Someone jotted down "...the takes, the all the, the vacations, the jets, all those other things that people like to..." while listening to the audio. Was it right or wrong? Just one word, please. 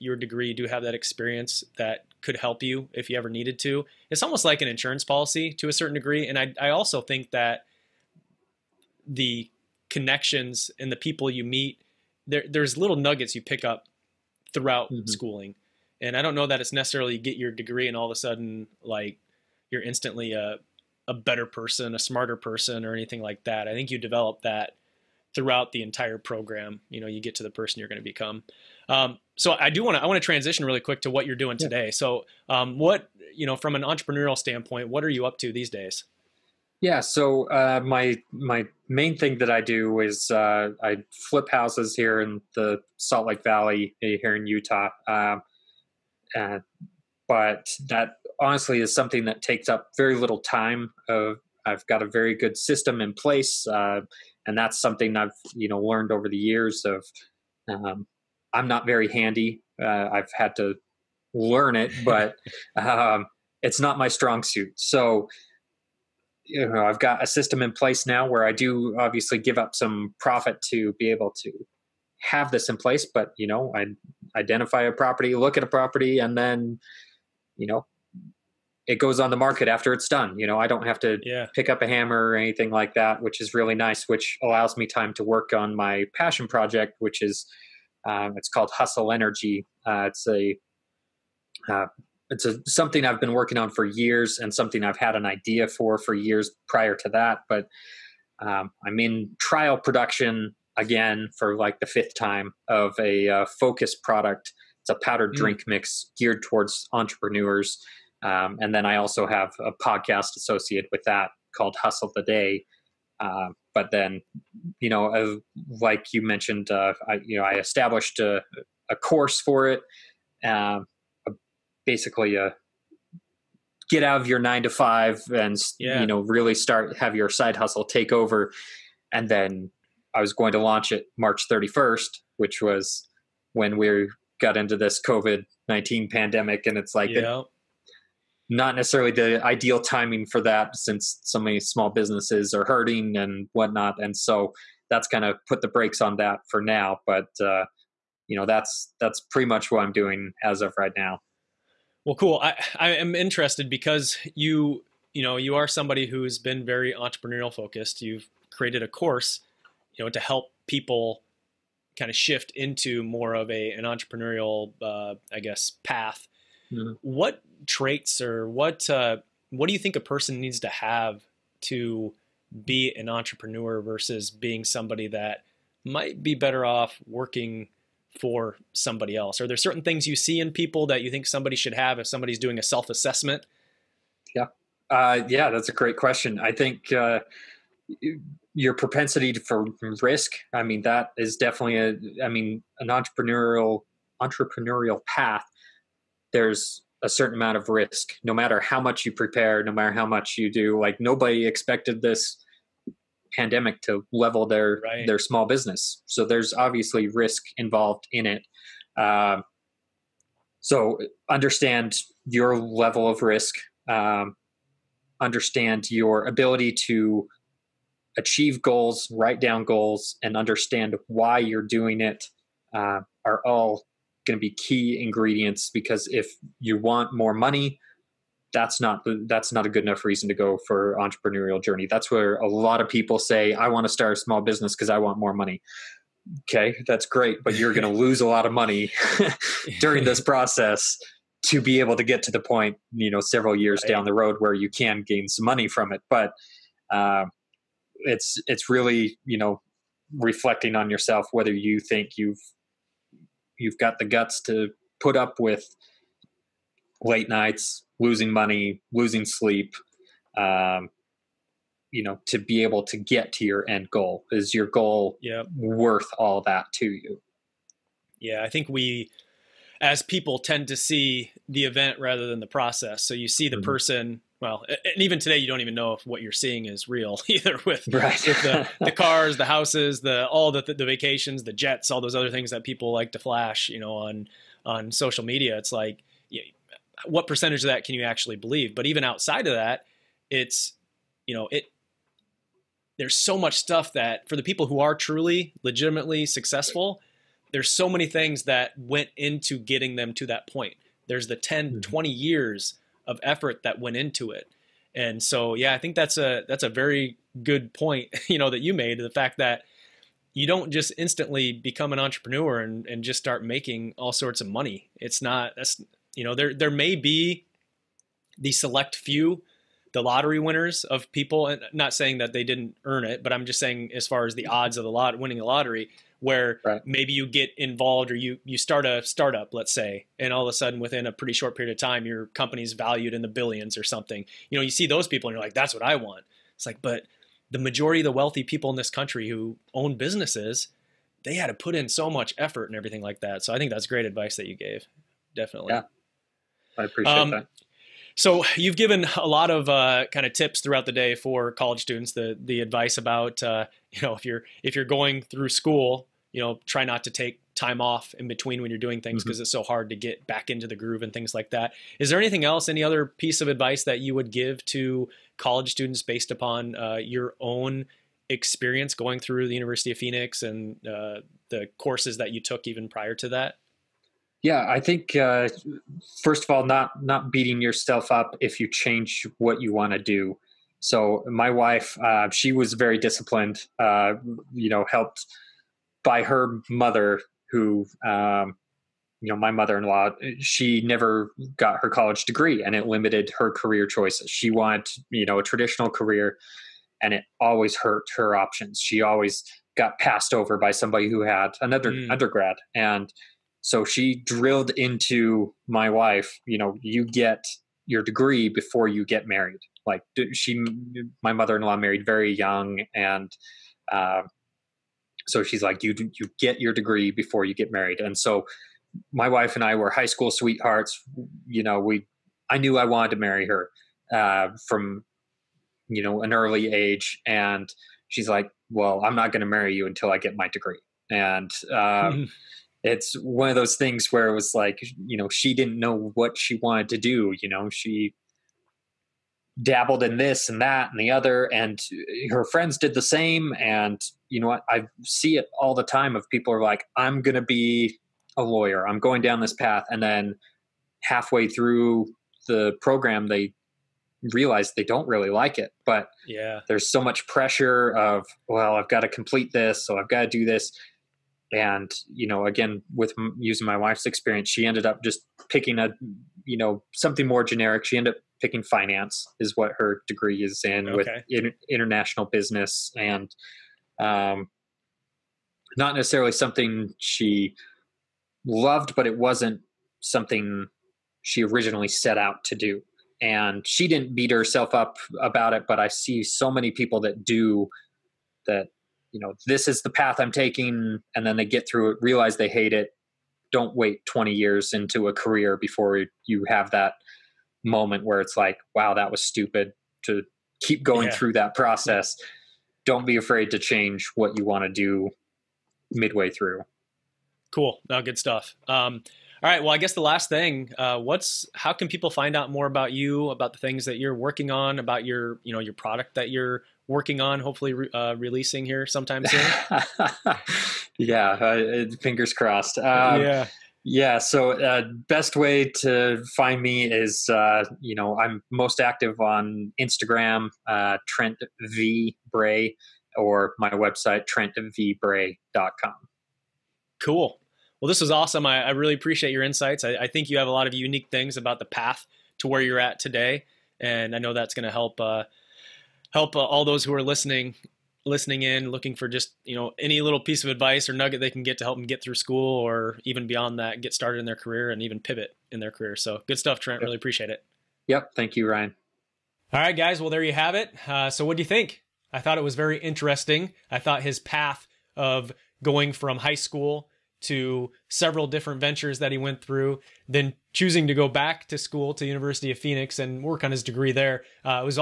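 wrong.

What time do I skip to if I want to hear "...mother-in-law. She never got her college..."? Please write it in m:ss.
6:29.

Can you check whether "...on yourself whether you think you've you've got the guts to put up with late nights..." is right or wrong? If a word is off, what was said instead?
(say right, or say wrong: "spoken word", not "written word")
right.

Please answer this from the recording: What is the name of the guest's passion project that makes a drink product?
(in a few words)
Hustle Energy.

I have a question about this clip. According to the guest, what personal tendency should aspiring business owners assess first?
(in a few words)
Propensity for risk.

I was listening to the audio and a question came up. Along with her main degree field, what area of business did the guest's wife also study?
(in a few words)
International business.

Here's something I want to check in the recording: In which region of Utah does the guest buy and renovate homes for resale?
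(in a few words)
Salt Lake Valley.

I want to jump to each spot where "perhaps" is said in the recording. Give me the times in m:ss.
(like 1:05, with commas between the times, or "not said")
not said.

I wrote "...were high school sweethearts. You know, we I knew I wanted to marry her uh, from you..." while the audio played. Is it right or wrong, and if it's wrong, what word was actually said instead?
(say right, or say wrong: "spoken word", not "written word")
right.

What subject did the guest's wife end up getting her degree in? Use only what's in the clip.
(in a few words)
Finance.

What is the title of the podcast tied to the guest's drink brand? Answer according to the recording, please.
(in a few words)
Hustle the Day.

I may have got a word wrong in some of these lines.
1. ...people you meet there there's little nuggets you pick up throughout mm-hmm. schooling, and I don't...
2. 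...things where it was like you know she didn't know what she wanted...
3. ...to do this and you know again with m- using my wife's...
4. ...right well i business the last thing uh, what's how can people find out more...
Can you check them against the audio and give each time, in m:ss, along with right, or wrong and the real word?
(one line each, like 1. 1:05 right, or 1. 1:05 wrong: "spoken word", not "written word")
1. 0:10 right
2. 7:13 right
3. 7:40 right
4. 8:29 wrong: "guess", not "business".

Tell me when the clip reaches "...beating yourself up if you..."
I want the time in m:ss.
6:17.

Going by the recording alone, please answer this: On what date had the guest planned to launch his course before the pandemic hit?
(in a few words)
March 31.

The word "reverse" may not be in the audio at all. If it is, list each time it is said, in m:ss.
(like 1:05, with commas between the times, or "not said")
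not said.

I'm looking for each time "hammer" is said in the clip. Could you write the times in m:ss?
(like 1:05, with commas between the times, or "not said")
1:21.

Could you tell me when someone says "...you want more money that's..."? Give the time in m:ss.
3:46.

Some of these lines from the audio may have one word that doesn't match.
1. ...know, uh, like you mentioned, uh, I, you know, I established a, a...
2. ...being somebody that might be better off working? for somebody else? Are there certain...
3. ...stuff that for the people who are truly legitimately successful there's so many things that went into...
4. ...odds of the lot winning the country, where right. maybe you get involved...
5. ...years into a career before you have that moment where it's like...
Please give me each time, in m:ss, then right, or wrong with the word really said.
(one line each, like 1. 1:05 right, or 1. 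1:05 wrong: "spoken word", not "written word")
1. 1:54 right
2. 2:54 right
3. 4:53 right
4. 5:24 wrong: "lottery", not "country"
5. 8:14 right.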